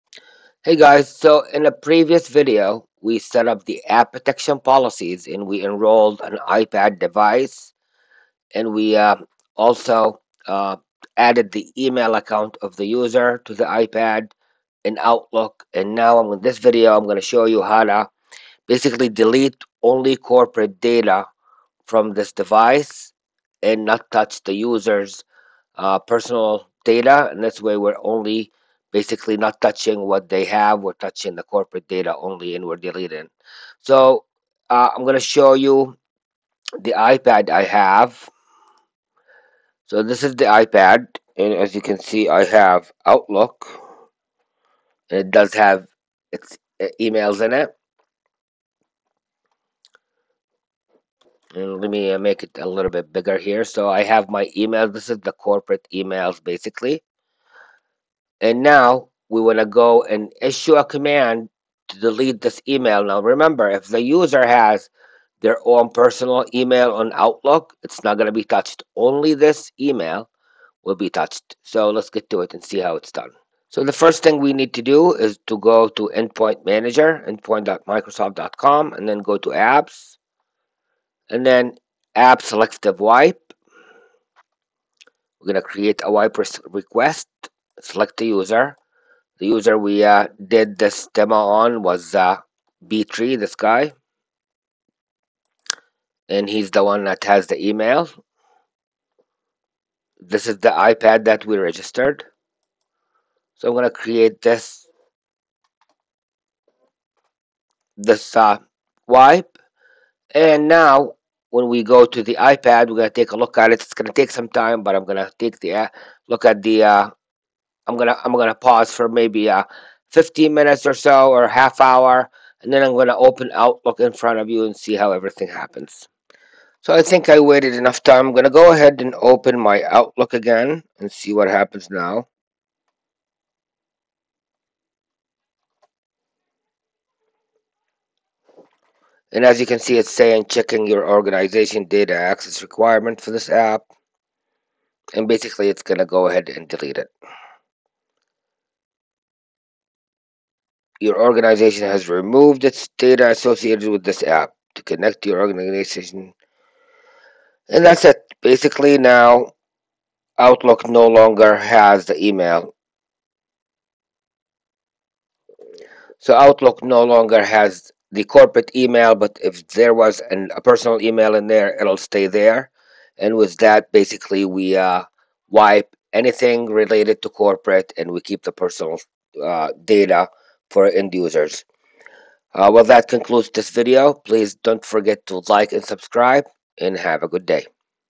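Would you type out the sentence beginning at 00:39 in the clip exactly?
So this is the iPad and as you can see I have Outlook and it does have its uh, emails in it.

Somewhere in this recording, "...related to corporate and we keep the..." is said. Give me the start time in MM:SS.
02:56.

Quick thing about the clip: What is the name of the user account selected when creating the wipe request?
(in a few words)
B3.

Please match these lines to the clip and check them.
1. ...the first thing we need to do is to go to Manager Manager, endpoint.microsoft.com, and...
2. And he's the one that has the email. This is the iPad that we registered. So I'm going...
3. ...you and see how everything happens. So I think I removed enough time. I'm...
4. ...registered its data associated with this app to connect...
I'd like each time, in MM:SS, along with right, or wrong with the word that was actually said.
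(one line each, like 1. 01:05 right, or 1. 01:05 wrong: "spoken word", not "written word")
1. 01:13 wrong: "Endpoint", not "Manager"
2. 01:36 right
3. 02:04 wrong: "waited", not "removed"
4. 02:32 wrong: "removed", not "registered".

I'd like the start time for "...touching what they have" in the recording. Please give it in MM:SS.
00:29.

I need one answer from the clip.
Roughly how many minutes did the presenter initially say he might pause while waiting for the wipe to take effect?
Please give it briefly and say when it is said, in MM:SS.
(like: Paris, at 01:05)
15, at 02:00.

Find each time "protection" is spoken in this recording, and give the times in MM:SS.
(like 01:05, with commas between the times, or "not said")
00:04.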